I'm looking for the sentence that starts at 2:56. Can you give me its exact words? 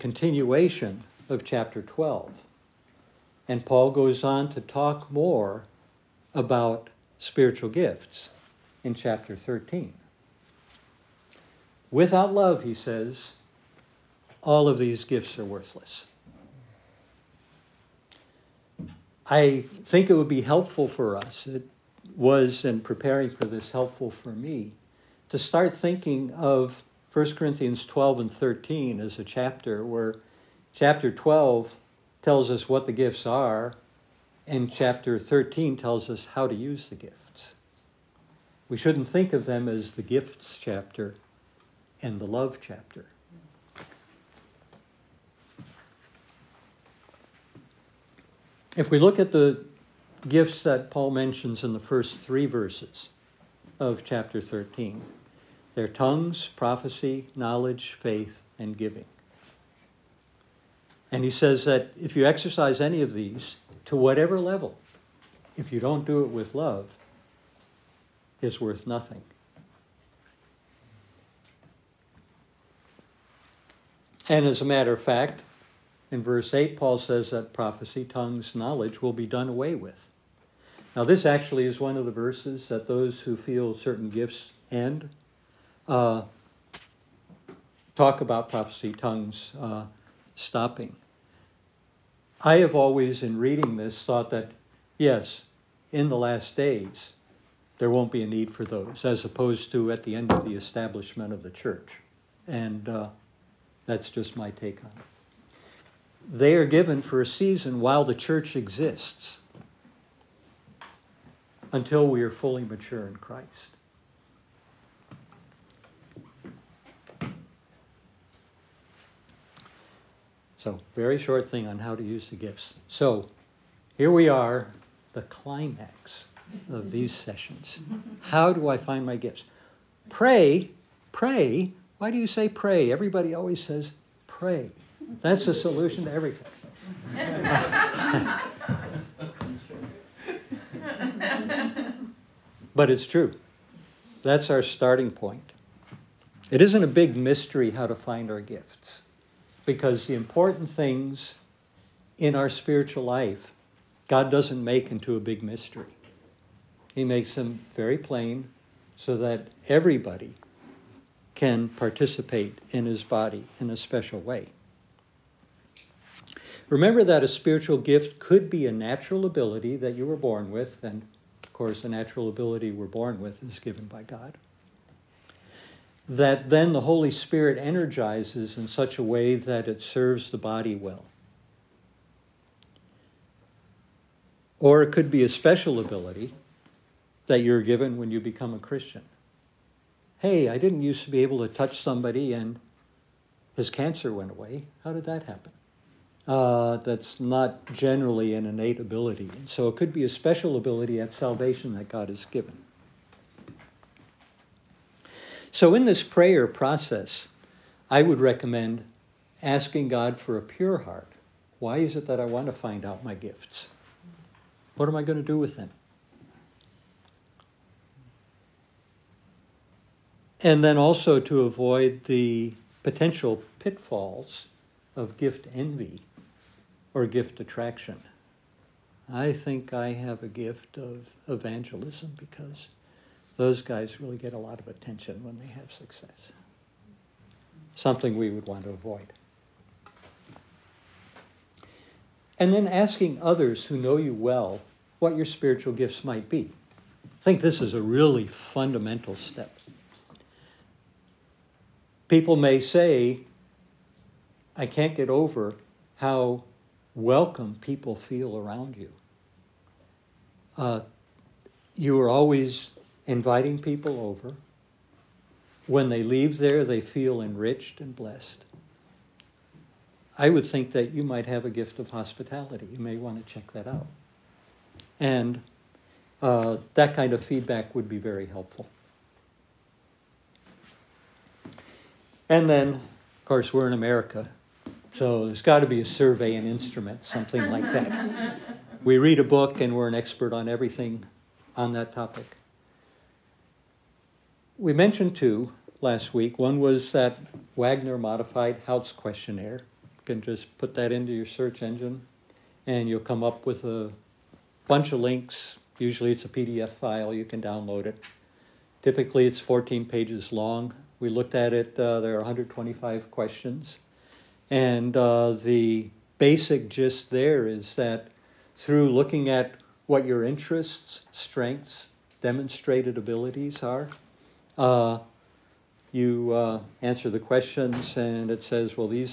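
That then the Holy Spirit energizes in such a way that it serves the body well.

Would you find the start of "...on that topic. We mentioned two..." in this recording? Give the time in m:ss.
4:51.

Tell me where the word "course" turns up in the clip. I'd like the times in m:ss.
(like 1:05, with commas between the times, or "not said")
2:51, 4:43.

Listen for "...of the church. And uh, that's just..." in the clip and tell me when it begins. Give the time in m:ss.
1:41.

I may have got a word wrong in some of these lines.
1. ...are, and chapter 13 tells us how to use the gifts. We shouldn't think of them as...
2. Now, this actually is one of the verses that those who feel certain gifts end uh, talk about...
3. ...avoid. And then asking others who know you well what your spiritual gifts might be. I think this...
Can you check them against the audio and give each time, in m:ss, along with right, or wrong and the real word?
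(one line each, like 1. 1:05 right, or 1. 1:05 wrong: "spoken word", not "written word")
1. 0:33 right
2. 1:20 right
3. 3:58 right.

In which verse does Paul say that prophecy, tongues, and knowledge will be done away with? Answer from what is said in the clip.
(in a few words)
Verse 8.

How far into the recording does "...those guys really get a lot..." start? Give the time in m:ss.
3:53.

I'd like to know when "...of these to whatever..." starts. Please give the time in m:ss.
1:03.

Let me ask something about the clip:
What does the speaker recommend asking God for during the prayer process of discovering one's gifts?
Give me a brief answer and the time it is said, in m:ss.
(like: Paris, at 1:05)
A pure heart, at 3:30.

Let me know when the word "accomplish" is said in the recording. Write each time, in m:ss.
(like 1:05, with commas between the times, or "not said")
not said.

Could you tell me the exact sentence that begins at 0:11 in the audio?
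Without love, he says, all of these gifts are worthless.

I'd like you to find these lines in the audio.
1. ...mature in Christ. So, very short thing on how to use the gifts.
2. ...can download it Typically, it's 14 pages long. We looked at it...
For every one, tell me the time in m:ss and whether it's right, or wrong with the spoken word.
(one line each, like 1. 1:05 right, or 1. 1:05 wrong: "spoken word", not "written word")
1. 1:52 right
2. 5:07 right.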